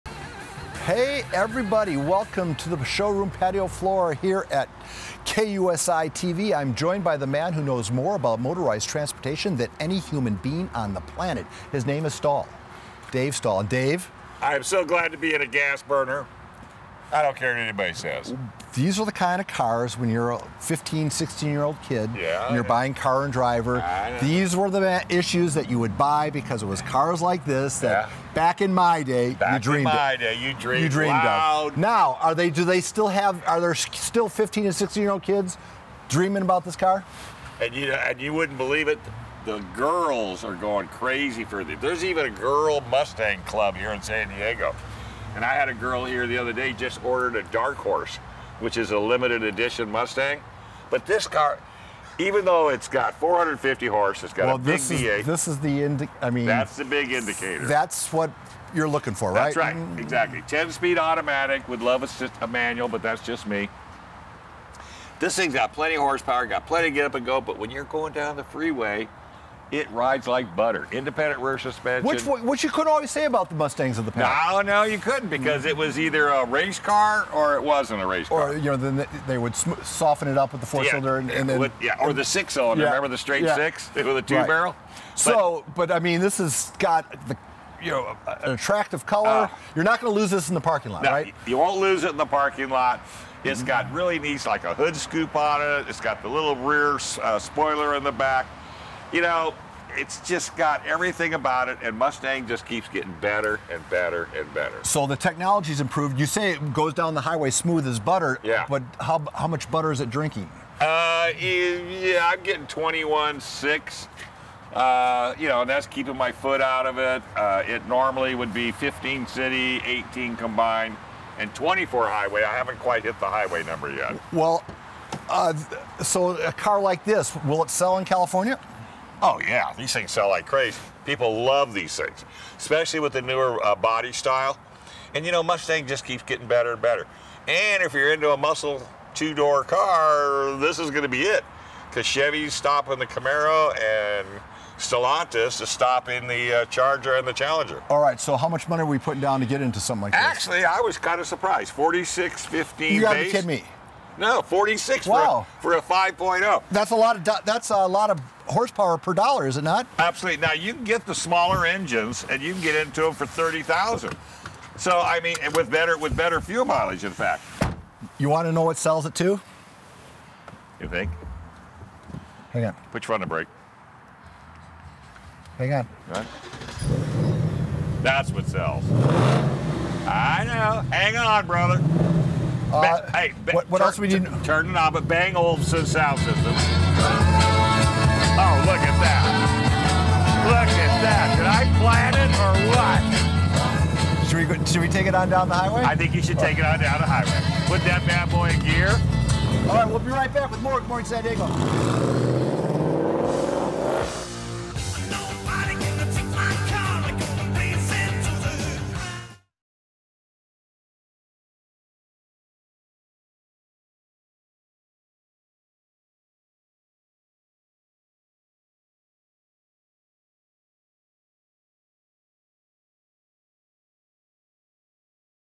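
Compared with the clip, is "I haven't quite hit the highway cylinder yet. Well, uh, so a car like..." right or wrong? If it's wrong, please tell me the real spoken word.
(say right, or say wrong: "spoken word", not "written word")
wrong: "number", not "cylinder".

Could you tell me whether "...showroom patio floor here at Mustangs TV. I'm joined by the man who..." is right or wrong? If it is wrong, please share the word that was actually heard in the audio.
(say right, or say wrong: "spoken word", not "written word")
wrong: "KUSI", not "Mustangs".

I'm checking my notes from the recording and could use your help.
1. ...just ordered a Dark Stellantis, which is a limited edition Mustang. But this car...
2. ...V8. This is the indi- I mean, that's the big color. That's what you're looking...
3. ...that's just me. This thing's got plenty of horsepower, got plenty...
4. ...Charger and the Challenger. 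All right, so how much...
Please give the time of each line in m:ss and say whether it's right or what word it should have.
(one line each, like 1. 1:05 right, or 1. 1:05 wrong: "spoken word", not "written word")
1. 0:46 wrong: "Horse", not "Stellantis"
2. 0:54 wrong: "indicator", not "color"
3. 1:03 right
4. 2:26 right.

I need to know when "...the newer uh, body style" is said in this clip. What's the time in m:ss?
2:13.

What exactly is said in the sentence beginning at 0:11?
His name is Stall, Dave Stall.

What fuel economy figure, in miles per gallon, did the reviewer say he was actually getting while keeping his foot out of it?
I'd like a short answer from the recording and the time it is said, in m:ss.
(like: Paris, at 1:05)
21.6, at 1:52.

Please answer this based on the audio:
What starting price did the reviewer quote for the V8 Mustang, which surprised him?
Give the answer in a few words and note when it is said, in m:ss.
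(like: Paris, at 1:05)
$46,015, at 2:31.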